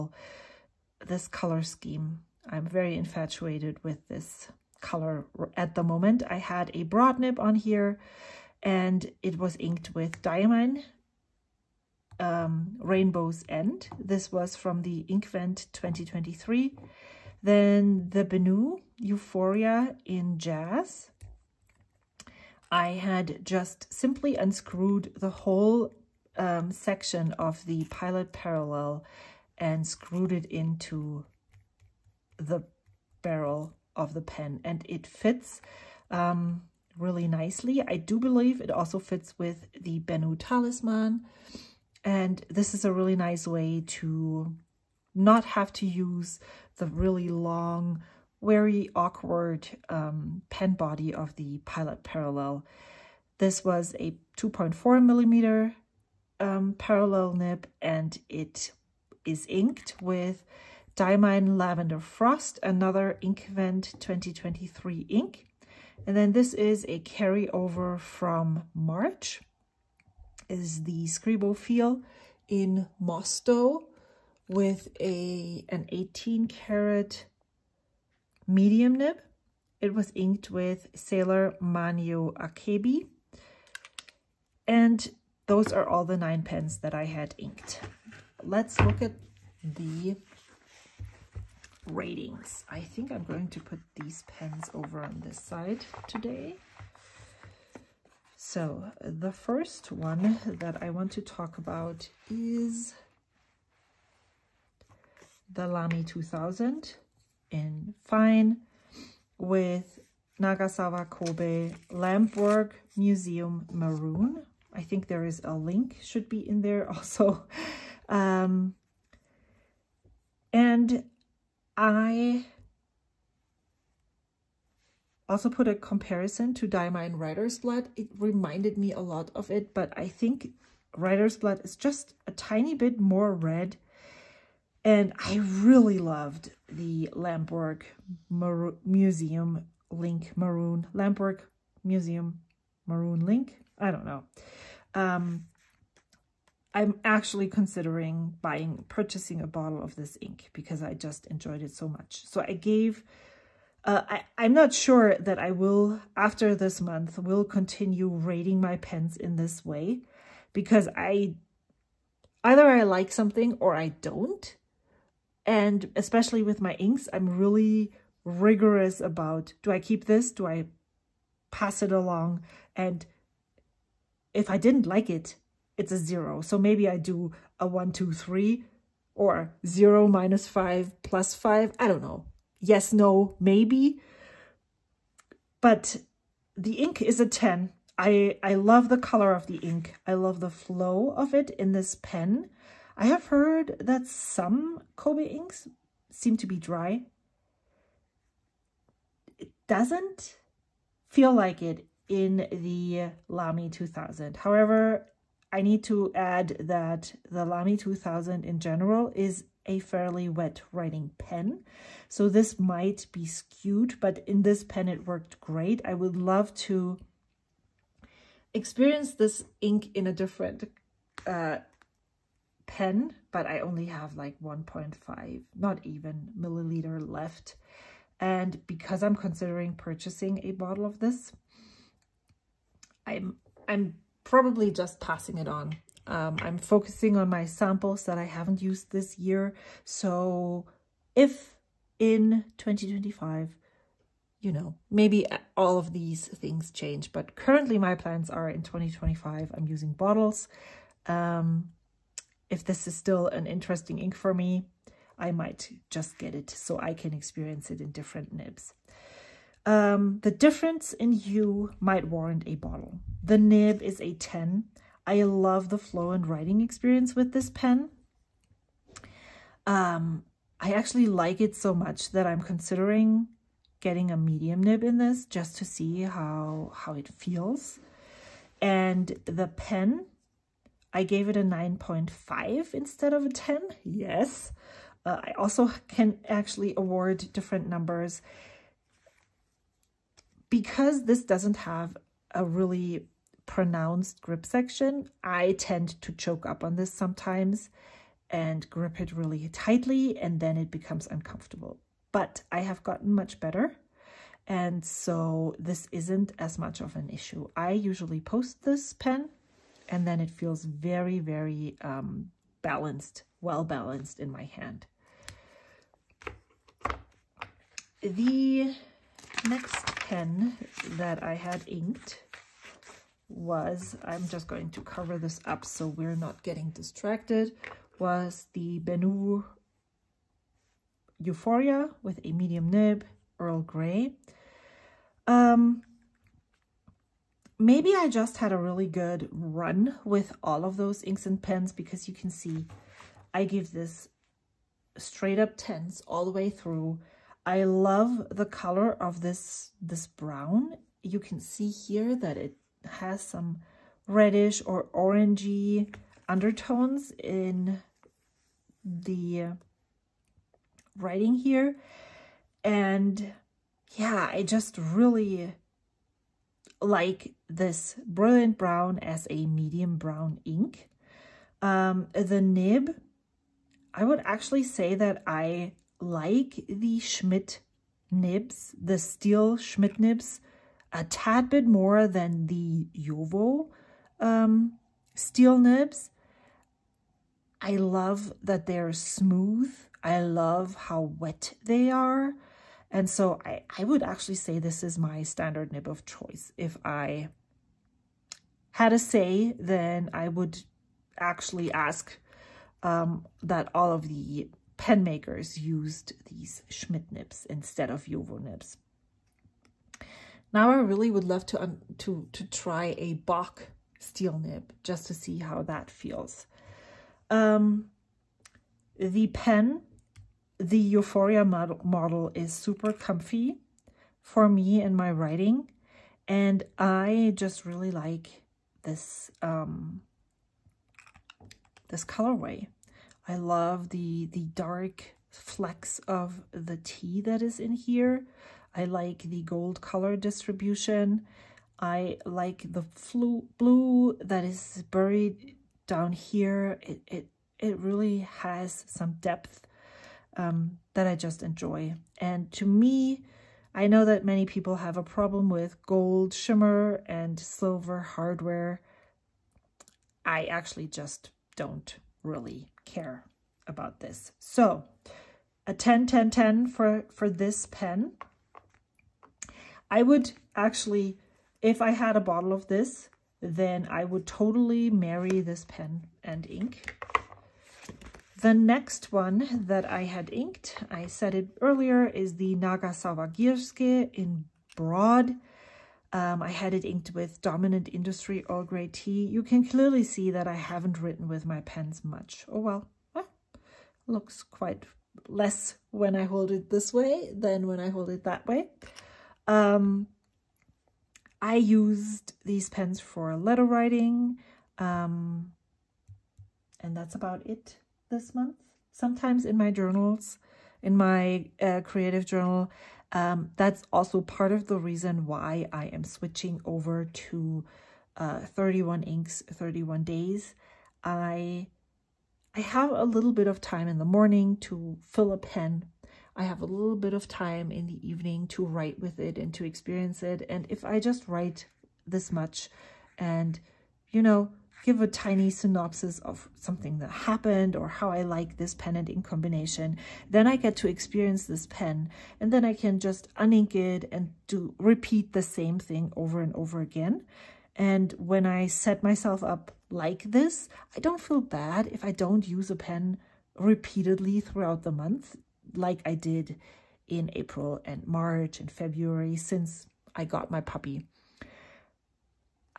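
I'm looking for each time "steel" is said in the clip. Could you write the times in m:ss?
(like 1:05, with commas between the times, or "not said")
6:18, 6:25, 6:53.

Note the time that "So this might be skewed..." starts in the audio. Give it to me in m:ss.
3:32.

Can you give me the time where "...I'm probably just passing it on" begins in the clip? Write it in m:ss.
3:53.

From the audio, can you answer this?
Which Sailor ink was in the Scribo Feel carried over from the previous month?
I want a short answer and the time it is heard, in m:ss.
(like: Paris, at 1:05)
Sailor Manyo Akebi, at 1:20.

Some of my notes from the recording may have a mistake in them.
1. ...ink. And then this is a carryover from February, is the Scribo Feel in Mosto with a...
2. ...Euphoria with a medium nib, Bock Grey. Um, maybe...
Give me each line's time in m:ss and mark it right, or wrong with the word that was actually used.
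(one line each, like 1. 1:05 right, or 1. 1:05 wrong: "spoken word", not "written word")
1. 1:05 wrong: "March", not "February"
2. 5:31 wrong: "Earl", not "Bock".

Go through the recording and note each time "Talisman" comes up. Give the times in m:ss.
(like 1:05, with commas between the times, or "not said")
0:40.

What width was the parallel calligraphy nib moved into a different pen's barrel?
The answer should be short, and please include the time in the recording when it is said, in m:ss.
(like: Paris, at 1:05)
2.4 millimeter, at 0:54.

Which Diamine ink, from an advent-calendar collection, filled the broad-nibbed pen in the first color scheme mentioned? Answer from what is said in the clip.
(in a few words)
Rainbow's End.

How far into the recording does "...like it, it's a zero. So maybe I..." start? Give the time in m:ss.
2:54.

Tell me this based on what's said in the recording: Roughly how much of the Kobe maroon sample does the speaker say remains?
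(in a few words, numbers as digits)
1.5 milliliter.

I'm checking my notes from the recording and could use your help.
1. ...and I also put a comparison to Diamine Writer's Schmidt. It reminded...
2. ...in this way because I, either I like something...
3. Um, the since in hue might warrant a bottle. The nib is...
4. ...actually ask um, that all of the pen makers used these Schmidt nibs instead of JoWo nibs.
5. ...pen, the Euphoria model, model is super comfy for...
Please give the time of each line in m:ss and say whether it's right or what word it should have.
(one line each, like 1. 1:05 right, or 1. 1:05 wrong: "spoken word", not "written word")
1. 2:00 wrong: "Blood", not "Schmidt"
2. 2:39 right
3. 4:19 wrong: "difference", not "since"
4. 6:41 right
5. 6:59 right.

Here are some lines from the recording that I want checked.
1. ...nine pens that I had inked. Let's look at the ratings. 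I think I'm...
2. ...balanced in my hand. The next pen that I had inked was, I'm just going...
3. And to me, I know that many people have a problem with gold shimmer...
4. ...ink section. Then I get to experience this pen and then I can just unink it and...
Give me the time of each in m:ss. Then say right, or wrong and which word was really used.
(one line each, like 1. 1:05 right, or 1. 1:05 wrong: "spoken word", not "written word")
1. 1:26 right
2. 5:13 right
3. 7:32 right
4. 8:59 wrong: "combination", not "section".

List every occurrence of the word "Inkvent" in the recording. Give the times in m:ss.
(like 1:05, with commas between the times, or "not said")
0:15, 1:03.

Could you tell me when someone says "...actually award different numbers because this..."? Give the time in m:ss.
4:46.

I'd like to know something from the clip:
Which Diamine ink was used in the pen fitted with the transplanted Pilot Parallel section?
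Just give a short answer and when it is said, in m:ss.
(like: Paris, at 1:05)
Lavender Frost, at 1:00.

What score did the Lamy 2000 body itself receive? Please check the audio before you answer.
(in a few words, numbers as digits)
9.5.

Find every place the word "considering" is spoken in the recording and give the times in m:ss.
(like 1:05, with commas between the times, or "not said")
2:27, 3:49, 4:32.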